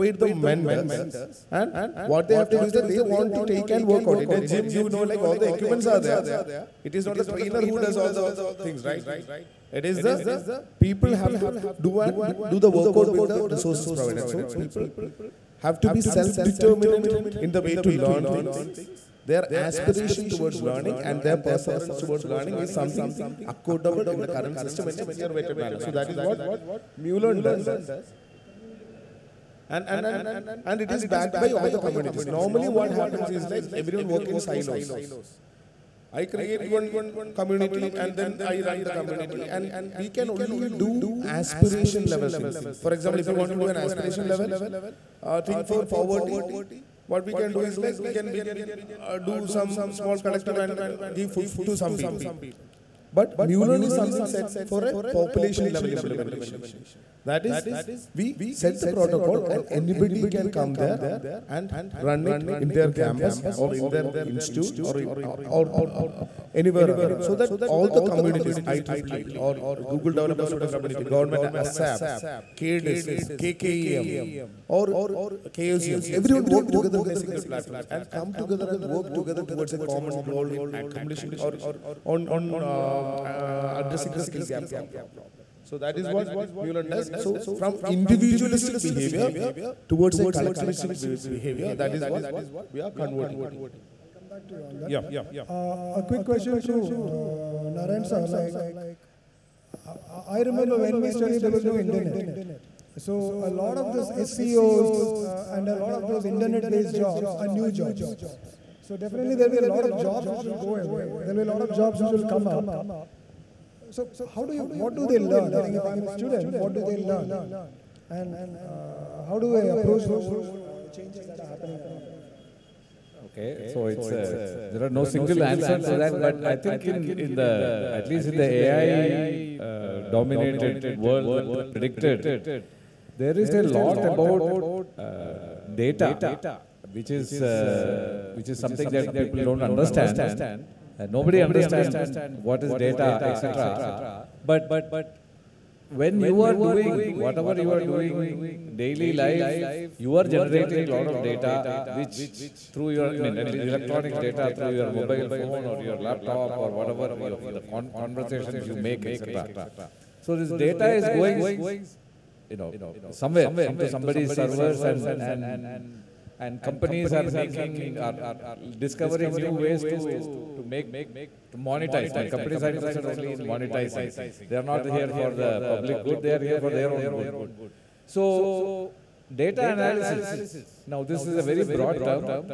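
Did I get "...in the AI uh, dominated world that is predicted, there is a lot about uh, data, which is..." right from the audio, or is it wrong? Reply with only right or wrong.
right.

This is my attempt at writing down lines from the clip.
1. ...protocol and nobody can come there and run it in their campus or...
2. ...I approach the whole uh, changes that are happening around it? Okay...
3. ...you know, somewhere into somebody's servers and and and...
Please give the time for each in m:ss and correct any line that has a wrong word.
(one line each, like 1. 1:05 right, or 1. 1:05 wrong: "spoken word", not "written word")
1. 0:58 wrong: "anybody", not "nobody"
2. 1:59 right
3. 2:42 right.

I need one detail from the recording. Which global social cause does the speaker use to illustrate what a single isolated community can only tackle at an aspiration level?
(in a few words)
Poverty.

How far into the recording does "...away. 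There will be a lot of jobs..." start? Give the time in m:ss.
1:50.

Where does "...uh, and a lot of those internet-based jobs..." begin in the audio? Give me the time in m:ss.
1:45.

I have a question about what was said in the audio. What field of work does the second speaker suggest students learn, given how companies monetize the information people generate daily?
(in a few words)
Data analysis.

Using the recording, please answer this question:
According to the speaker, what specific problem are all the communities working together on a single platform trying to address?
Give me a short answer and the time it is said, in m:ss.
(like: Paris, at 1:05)
Skill gap, at 1:24.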